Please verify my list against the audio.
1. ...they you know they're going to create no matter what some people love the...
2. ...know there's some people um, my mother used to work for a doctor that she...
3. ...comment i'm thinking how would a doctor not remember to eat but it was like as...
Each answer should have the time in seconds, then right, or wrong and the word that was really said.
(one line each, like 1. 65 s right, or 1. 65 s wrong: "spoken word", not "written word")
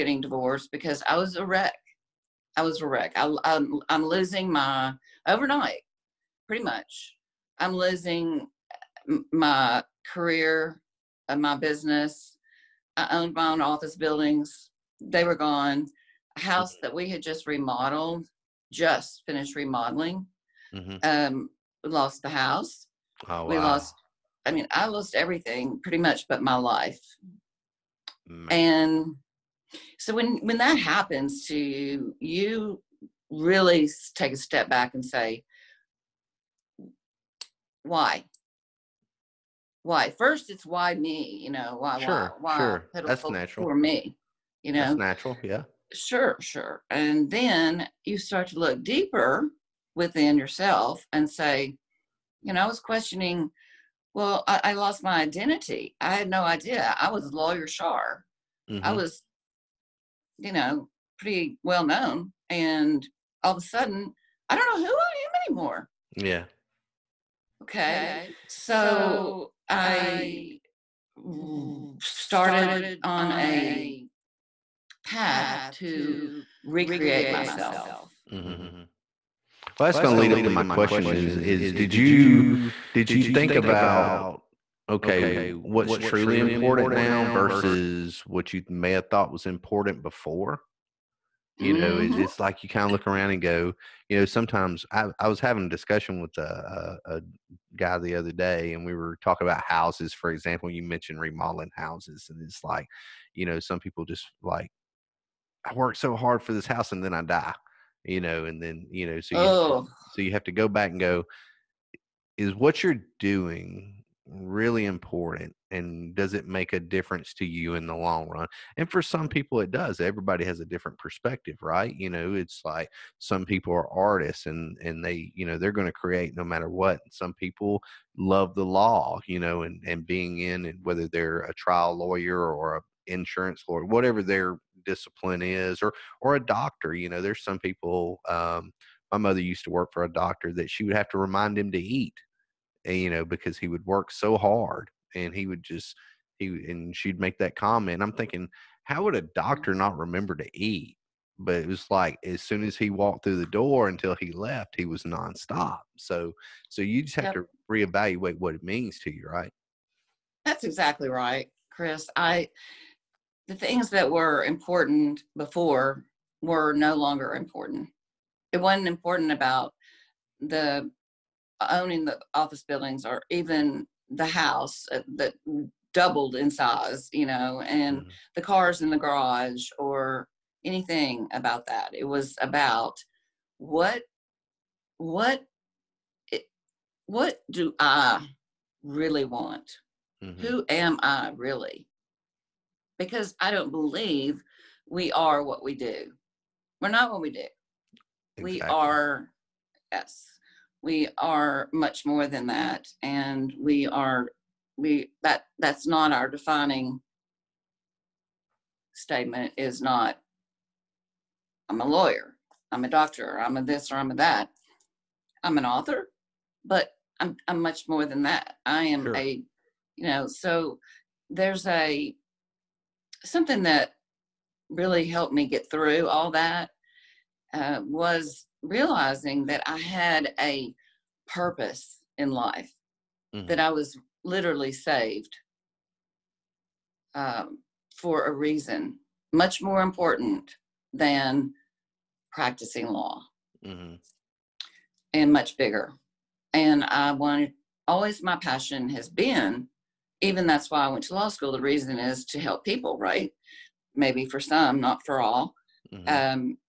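1. 125 s right
2. 137 s right
3. 147 s right.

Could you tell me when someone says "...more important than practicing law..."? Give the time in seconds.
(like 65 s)
239 s.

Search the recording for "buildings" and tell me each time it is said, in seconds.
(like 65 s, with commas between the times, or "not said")
13 s, 172 s.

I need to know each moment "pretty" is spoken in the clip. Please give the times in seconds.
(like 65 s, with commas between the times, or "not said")
6 s, 25 s, 61 s.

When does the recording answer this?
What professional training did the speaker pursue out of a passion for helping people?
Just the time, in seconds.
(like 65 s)
251 s.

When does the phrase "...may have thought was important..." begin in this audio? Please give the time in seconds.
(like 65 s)
88 s.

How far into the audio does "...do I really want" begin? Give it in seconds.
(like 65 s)
187 s.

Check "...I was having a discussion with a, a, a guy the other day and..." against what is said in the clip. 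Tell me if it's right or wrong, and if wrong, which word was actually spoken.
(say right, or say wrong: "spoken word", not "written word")
right.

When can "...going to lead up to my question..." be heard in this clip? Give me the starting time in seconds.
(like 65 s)
79 s.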